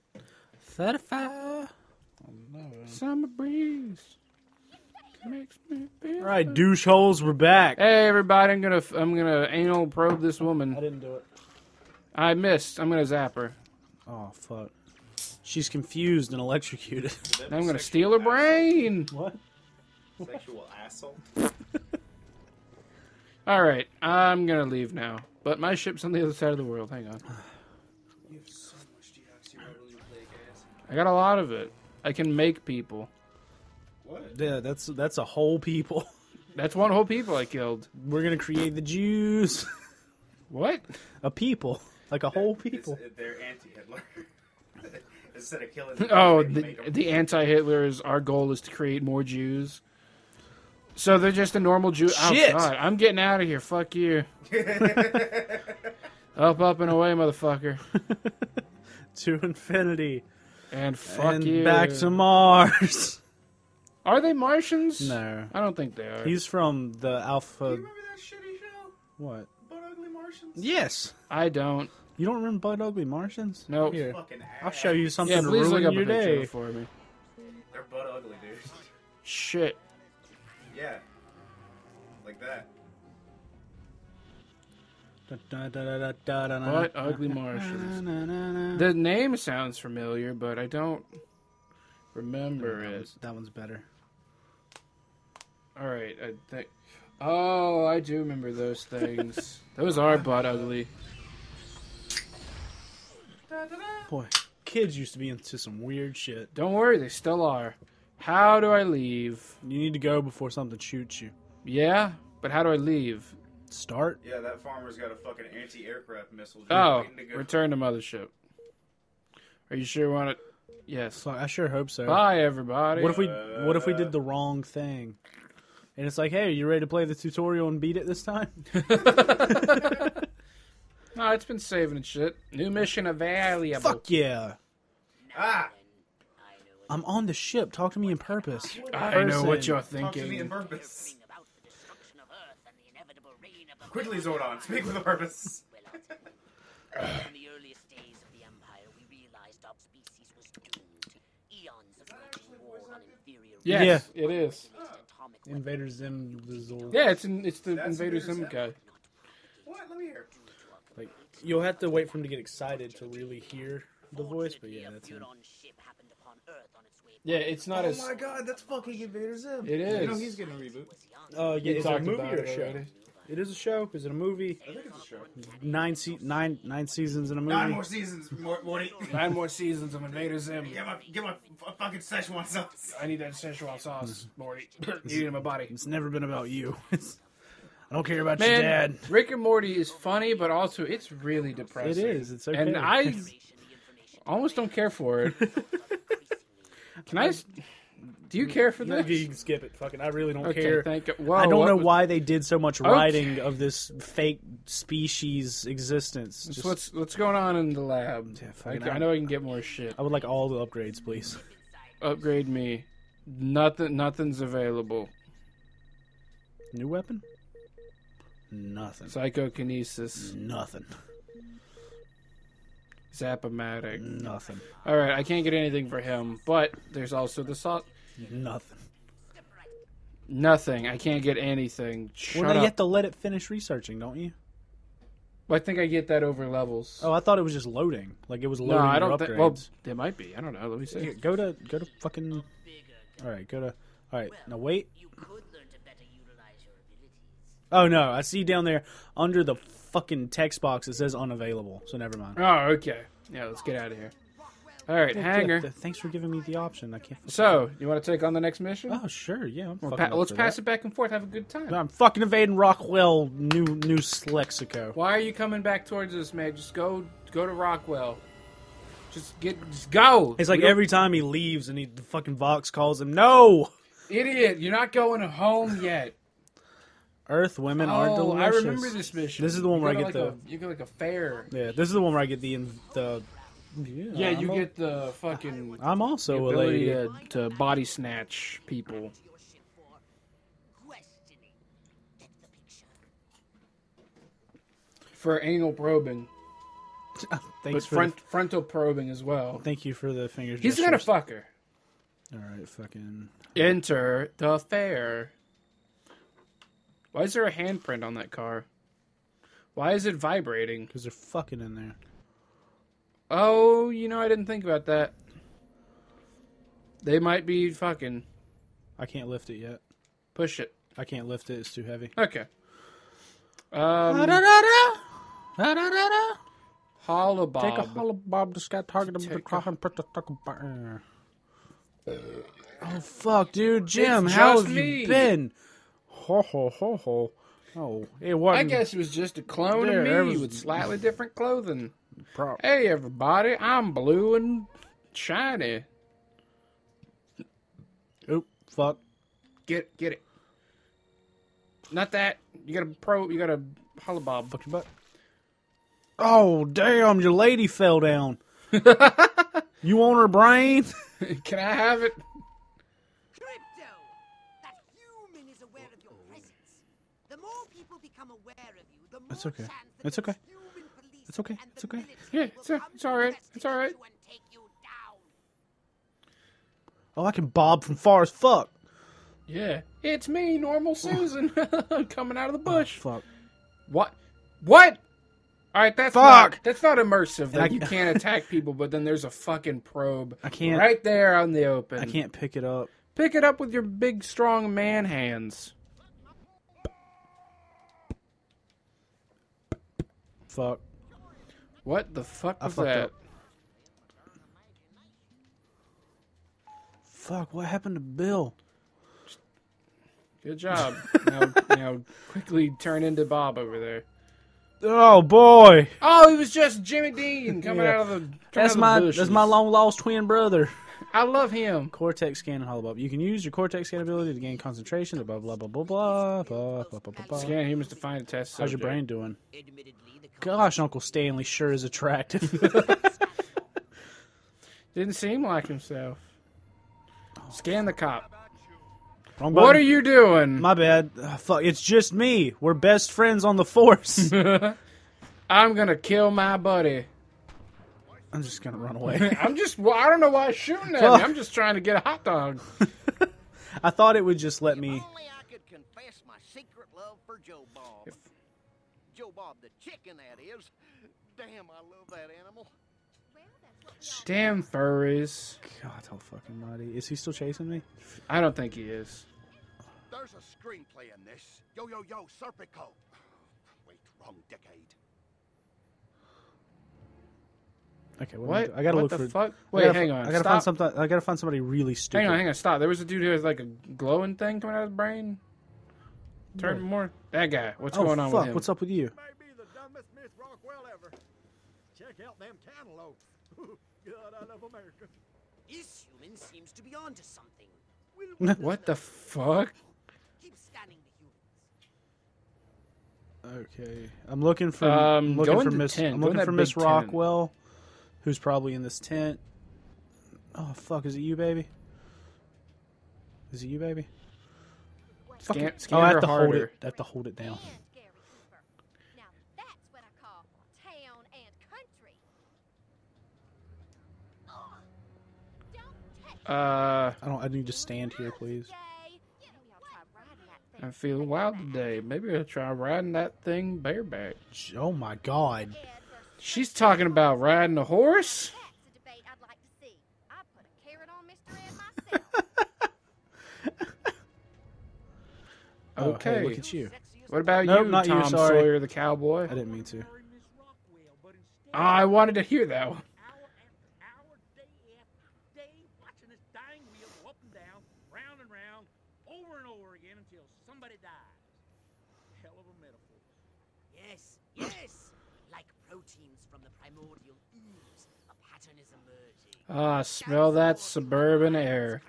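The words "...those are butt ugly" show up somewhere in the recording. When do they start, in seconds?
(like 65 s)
99 s.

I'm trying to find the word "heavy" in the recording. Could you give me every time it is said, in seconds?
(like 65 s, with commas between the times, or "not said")
321 s.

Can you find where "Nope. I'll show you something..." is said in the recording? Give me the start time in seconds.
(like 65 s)
73 s.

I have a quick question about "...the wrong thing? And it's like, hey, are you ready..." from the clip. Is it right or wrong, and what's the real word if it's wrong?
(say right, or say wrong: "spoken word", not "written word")
right.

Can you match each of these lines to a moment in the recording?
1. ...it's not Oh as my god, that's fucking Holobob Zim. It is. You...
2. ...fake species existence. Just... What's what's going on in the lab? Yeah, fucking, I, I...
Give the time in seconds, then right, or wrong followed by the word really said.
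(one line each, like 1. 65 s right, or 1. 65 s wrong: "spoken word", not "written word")
1. 167 s wrong: "Invader", not "Holobob"
2. 203 s right.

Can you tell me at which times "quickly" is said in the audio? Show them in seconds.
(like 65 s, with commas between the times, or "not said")
143 s, 412 s.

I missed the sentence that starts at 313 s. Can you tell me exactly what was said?
Oh, you know, I didn't think about that.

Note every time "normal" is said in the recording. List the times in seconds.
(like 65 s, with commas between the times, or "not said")
51 s, 380 s.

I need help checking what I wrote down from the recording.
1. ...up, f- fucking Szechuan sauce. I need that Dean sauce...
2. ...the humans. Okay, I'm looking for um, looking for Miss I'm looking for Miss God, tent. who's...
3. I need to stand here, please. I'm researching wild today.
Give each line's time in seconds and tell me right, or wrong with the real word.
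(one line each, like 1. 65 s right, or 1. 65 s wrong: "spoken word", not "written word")
1. 181 s wrong: "Szechuan", not "Dean"
2. 503 s wrong: "Rockwell", not "God"
3. 527 s wrong: "feeling", not "researching".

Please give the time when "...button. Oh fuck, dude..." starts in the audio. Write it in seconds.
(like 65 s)
330 s.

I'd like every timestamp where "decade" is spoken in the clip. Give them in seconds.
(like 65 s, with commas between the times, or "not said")
474 s.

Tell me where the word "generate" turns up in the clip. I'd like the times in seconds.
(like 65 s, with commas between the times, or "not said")
not said.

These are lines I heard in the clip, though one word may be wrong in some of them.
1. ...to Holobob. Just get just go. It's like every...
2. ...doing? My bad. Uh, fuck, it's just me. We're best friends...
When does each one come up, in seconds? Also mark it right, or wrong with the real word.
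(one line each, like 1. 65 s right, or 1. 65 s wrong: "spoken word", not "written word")
1. 267 s wrong: "Rockwell", not "Holobob"
2. 440 s right.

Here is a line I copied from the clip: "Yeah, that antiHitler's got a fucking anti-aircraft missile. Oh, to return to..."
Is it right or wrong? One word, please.
wrong.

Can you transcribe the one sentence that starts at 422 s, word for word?
You can use your cortex scan ability to gain concentration.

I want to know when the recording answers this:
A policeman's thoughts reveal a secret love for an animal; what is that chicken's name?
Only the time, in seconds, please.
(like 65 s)
457 s.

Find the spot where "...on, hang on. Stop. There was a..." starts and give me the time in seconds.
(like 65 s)
482 s.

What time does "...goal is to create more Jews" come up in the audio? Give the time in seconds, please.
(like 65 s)
48 s.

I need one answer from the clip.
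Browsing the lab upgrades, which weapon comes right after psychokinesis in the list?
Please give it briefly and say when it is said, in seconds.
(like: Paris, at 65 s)
Zapomatic, at 223 s.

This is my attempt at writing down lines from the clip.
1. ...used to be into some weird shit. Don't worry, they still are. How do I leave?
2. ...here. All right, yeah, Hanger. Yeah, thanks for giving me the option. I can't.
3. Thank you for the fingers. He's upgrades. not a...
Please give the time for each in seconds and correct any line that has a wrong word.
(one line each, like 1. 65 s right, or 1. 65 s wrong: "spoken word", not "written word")
1. 104 s right
2. 253 s right
3. 299 s wrong: "gestures", not "upgrades".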